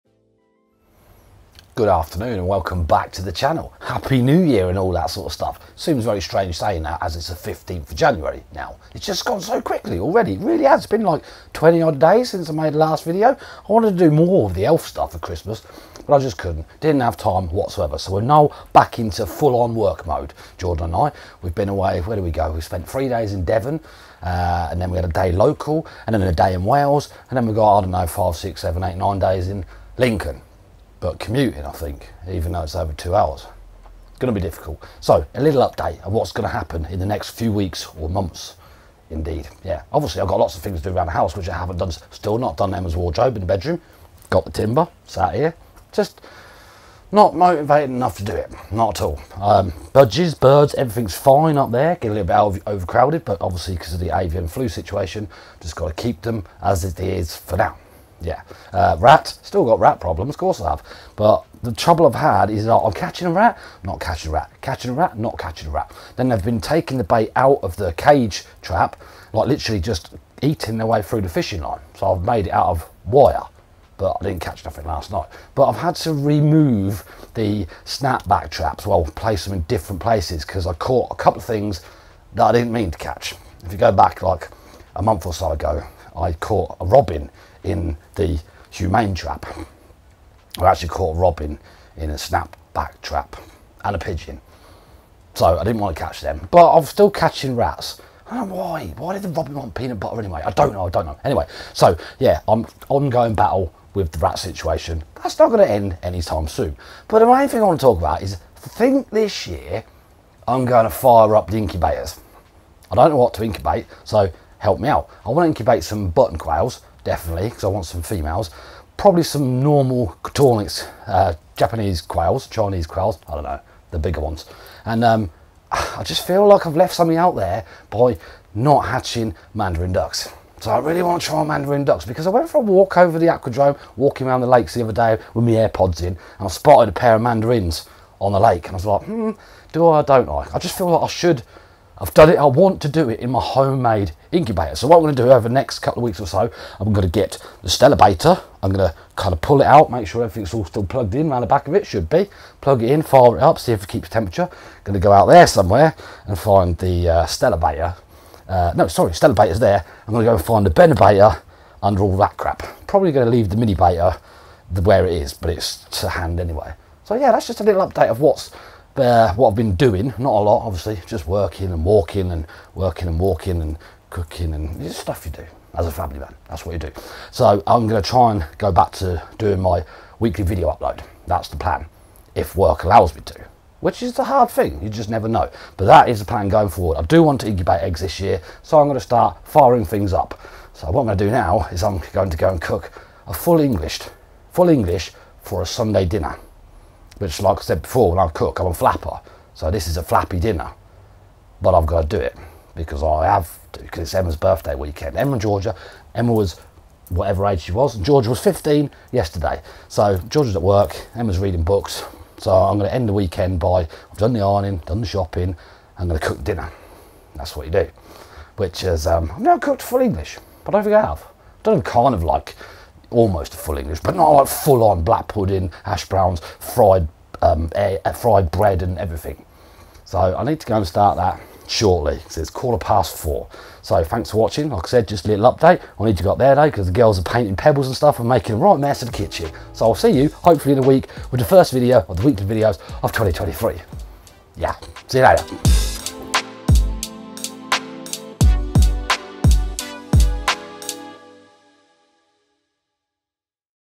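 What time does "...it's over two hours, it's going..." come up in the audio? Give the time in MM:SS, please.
00:32.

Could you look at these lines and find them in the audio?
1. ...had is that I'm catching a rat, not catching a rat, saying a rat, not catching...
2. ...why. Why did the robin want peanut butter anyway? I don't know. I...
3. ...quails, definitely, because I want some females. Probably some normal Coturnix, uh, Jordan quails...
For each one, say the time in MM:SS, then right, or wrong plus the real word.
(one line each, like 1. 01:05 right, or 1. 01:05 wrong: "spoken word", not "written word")
1. 01:02 wrong: "catching", not "saying"
2. 01:38 right
3. 01:56 wrong: "Japanese", not "Jordan".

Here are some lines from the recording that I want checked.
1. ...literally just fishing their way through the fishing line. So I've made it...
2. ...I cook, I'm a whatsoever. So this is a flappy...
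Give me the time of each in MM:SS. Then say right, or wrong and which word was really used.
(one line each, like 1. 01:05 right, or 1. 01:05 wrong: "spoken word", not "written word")
1. 01:09 wrong: "eating", not "fishing"
2. 03:18 wrong: "flapper", not "whatsoever".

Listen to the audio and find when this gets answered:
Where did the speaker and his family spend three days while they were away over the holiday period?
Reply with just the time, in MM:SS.
00:23.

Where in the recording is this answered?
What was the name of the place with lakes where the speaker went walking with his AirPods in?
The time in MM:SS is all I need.
02:13.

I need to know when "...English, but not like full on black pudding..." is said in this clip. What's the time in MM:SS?
03:43.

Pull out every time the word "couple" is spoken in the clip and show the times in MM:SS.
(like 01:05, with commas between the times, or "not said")
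01:21, 02:25.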